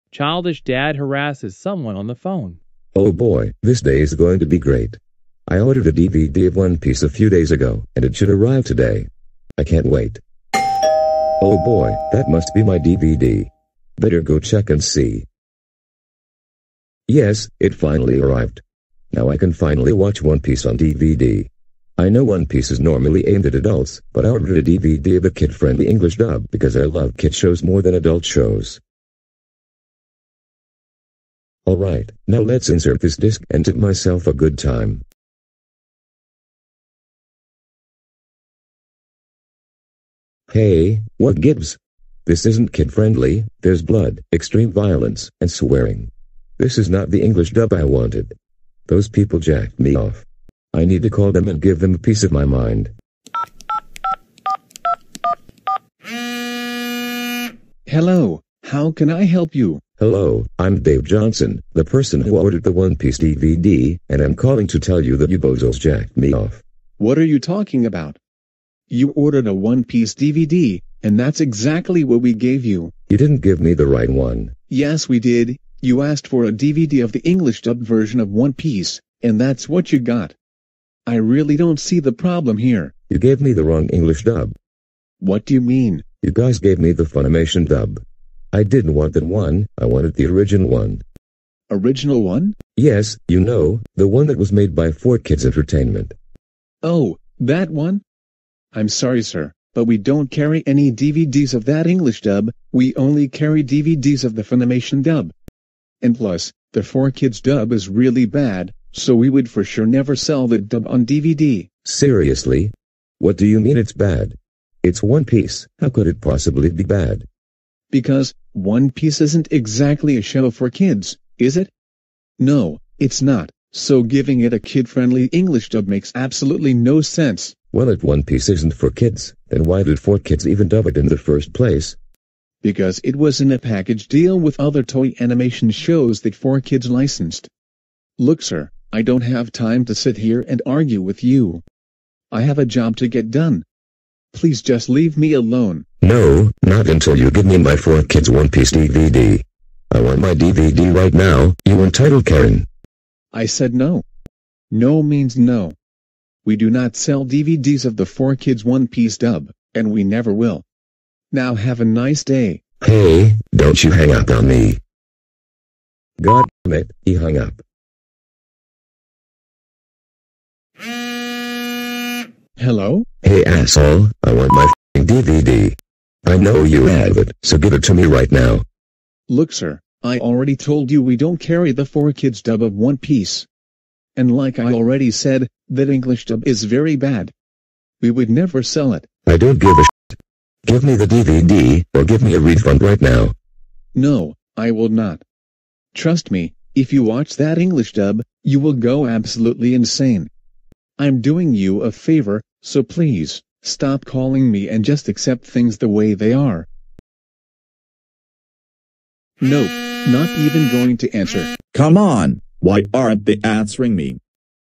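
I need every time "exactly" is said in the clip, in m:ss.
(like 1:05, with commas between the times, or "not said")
1:11, 1:59.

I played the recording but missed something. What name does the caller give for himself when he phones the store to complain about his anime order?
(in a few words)
Dave Johnson.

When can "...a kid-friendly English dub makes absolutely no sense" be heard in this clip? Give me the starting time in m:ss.
2:04.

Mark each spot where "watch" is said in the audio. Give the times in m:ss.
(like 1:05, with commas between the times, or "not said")
0:19, 3:17.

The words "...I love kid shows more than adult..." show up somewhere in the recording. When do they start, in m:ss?
0:26.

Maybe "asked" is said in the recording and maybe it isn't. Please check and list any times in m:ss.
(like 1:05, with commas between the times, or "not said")
1:16.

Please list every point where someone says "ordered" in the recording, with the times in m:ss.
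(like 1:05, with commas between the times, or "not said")
0:05, 0:24, 1:02, 1:09.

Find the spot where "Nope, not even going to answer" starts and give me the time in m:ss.
3:29.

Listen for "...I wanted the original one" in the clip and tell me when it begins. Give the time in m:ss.
1:29.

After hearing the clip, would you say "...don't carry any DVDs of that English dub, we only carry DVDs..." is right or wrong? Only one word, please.
right.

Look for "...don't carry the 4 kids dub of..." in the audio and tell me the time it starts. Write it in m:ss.
3:01.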